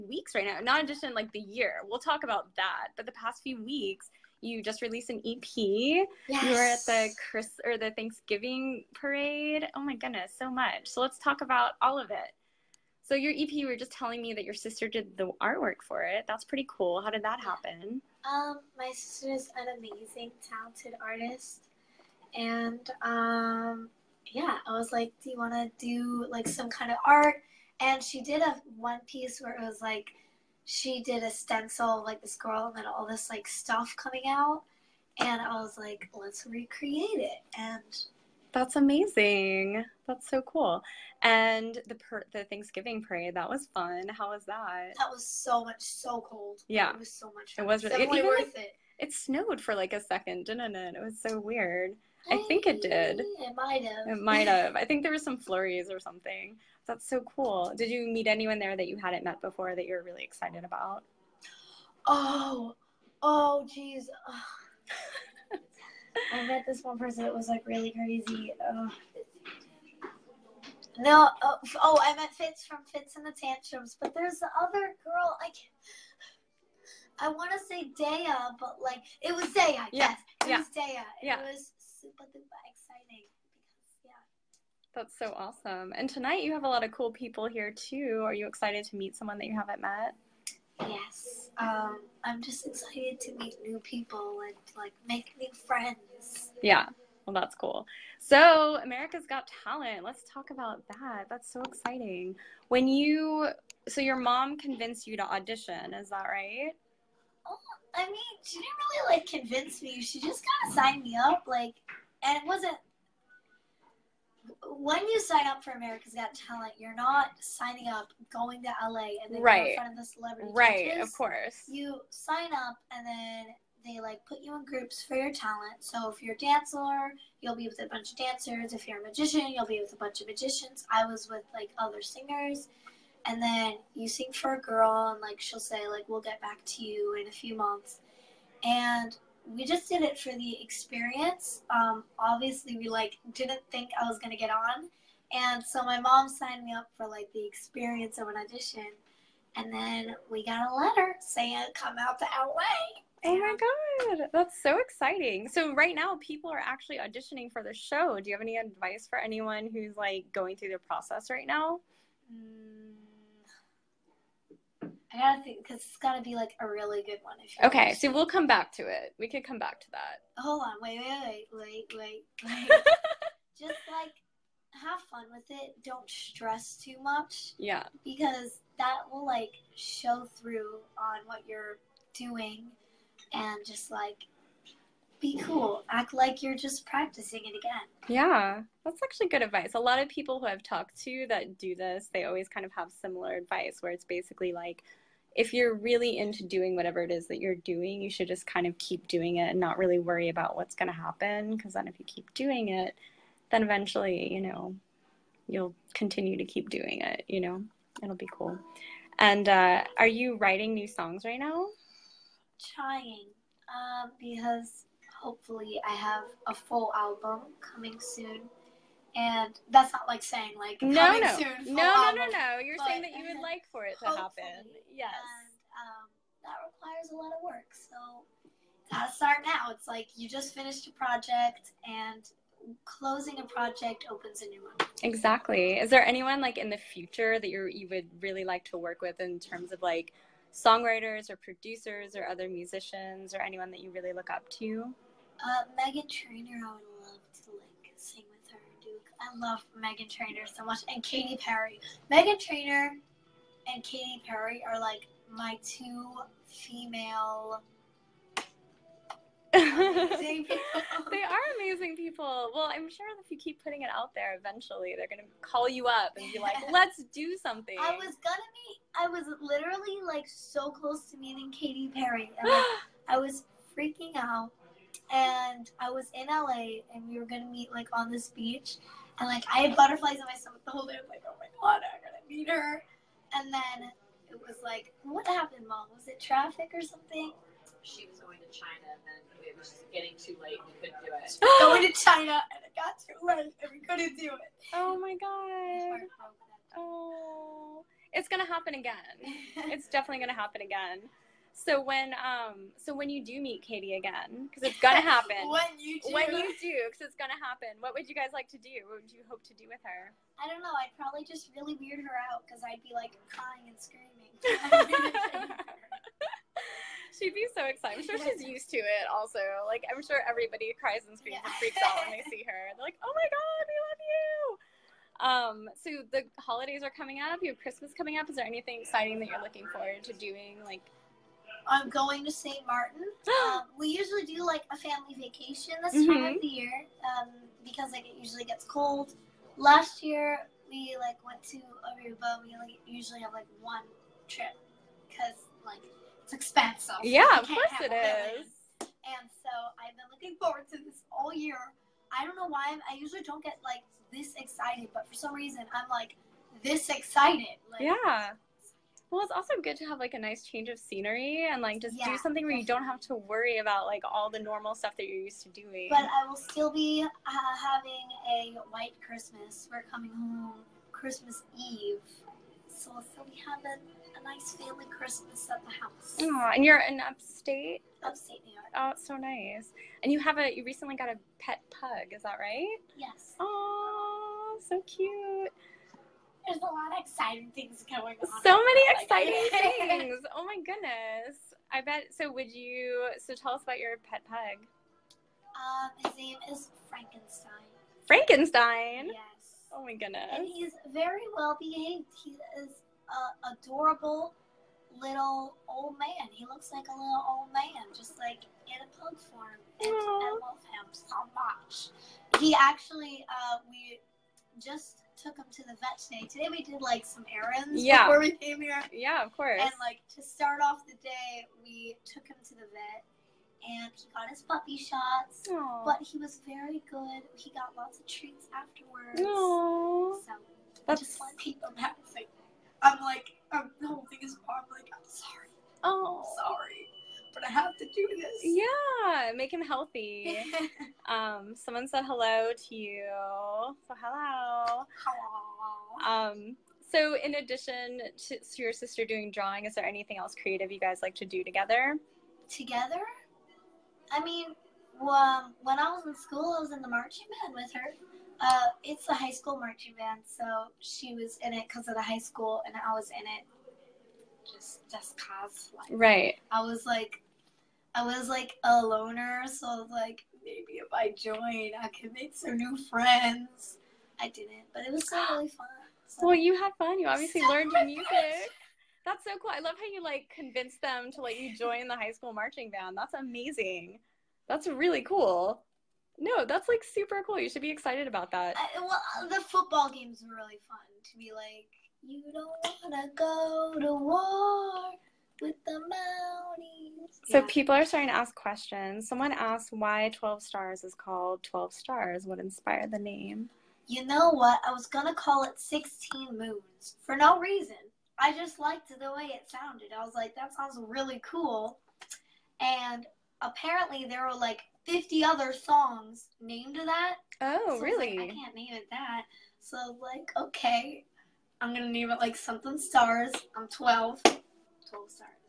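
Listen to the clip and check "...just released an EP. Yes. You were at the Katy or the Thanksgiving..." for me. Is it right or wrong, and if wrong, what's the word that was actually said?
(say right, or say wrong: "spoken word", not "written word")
wrong: "Chris", not "Katy".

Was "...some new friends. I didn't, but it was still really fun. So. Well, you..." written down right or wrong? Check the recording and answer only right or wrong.
right.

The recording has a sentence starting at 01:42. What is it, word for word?
When you, so your mom convinced you to audition, is that right?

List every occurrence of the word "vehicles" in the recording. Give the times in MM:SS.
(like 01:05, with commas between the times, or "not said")
not said.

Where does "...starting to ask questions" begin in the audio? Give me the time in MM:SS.
08:17.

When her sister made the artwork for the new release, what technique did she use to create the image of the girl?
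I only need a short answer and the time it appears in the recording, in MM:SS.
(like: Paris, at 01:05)
Stencil, at 00:31.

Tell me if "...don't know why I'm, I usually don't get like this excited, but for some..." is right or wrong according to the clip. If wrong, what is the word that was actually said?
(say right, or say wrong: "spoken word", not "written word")
right.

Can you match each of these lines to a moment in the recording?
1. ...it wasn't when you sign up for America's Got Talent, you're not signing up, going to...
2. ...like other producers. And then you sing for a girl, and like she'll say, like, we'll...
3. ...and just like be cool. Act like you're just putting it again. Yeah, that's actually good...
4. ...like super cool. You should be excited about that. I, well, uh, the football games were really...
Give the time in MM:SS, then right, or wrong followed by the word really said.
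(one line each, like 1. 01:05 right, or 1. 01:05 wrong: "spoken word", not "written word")
1. 01:52 right
2. 02:11 wrong: "singers", not "producers"
3. 03:03 wrong: "practicing", not "putting"
4. 08:06 right.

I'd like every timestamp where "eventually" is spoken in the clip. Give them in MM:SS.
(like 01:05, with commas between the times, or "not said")
03:23, 04:24.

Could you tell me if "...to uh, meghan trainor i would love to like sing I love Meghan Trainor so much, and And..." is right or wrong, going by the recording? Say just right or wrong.
wrong.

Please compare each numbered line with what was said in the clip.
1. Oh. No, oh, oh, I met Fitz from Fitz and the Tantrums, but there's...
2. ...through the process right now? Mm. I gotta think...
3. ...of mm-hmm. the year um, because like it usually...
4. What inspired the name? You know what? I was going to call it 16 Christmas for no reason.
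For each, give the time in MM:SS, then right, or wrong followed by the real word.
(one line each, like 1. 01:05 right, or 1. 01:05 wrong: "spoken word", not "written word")
1. 01:08 right
2. 02:40 right
3. 05:36 right
4. 08:22 wrong: "Moons", not "Christmas".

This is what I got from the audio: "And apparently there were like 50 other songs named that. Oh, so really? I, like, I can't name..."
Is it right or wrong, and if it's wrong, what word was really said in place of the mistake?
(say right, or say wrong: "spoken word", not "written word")
right.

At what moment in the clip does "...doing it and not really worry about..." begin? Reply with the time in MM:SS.
03:19.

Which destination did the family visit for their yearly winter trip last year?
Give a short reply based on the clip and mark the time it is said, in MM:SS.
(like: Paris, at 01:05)
Aruba, at 05:41.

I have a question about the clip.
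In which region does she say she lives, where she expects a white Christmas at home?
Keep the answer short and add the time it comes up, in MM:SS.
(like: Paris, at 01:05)
Upstate New York, at 06:18.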